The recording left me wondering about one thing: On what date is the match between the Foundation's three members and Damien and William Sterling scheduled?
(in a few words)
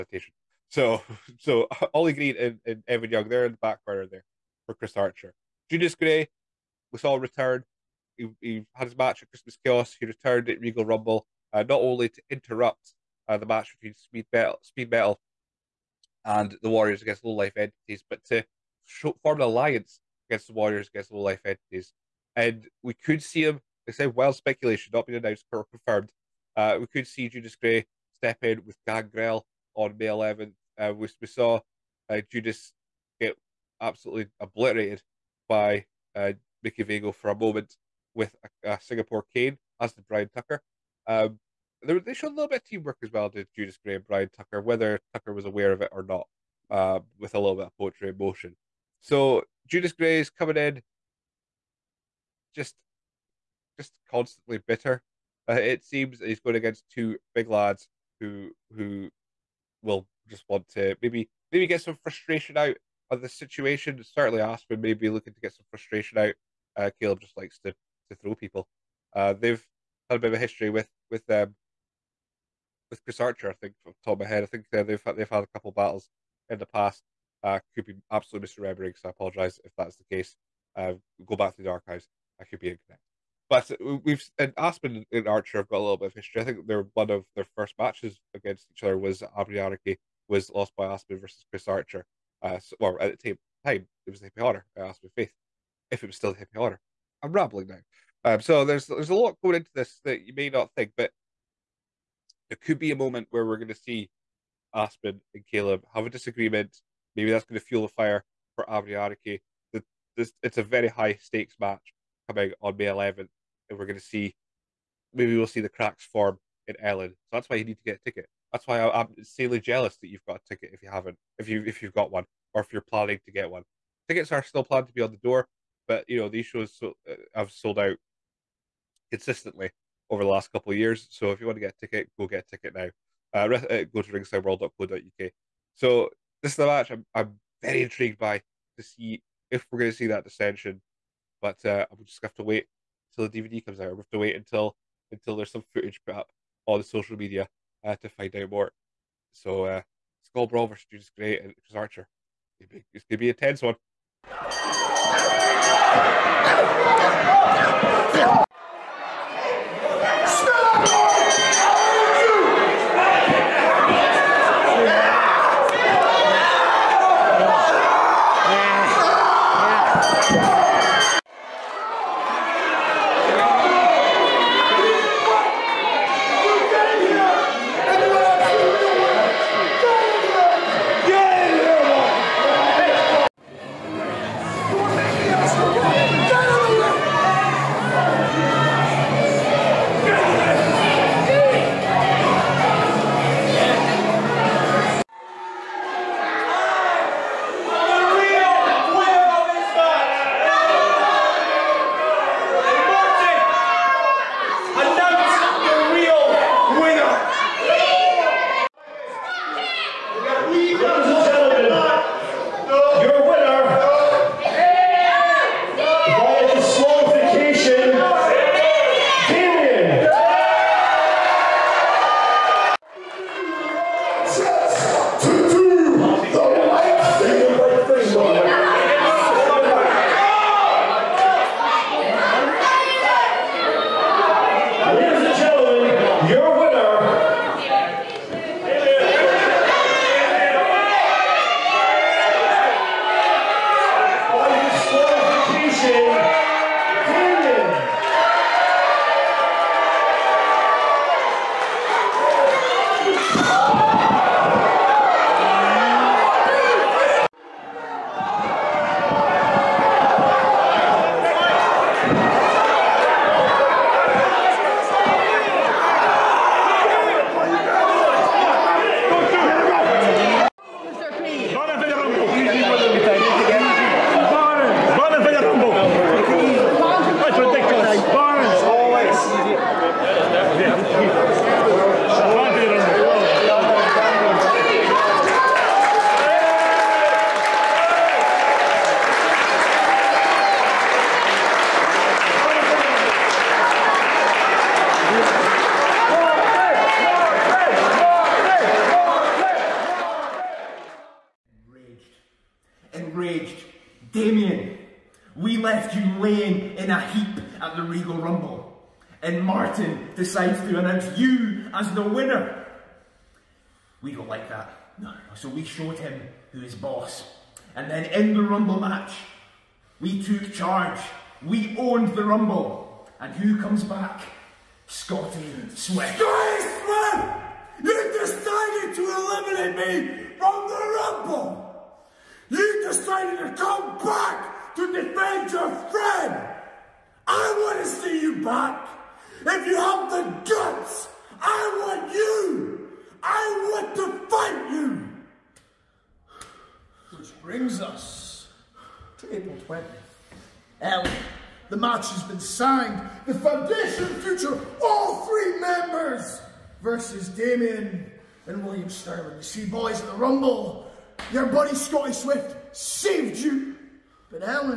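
April 20th.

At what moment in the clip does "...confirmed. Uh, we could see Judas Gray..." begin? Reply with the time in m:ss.
0:25.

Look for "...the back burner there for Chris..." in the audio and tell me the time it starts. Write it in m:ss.
0:03.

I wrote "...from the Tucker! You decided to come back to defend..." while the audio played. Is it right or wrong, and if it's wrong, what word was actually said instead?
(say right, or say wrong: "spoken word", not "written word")
wrong: "Rumble", not "Tucker".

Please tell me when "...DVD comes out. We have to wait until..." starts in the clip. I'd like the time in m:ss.
2:23.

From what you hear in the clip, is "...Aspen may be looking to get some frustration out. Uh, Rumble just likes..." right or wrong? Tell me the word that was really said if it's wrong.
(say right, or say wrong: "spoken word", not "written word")
wrong: "Caleb", not "Rumble".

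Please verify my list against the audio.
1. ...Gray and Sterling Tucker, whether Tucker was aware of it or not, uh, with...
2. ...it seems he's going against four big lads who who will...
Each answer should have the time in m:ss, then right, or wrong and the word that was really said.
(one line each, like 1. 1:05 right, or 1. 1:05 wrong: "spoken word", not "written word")
1. 0:43 wrong: "Brian", not "Sterling"
2. 0:55 wrong: "two", not "four".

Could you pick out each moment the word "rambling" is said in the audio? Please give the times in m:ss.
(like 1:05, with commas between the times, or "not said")
1:37.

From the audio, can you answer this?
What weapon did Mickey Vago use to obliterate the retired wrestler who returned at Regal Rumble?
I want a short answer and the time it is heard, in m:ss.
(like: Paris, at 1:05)
Singapore cane, at 0:38.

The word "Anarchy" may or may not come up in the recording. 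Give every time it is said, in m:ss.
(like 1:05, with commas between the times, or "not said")
1:29, 1:48.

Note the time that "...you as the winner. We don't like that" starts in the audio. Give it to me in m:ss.
5:11.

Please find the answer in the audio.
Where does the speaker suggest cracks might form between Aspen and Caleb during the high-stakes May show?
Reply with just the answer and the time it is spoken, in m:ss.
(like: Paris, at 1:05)
Ellon, at 1:56.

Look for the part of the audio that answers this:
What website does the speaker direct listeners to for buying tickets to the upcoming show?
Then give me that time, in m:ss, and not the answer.
2:14.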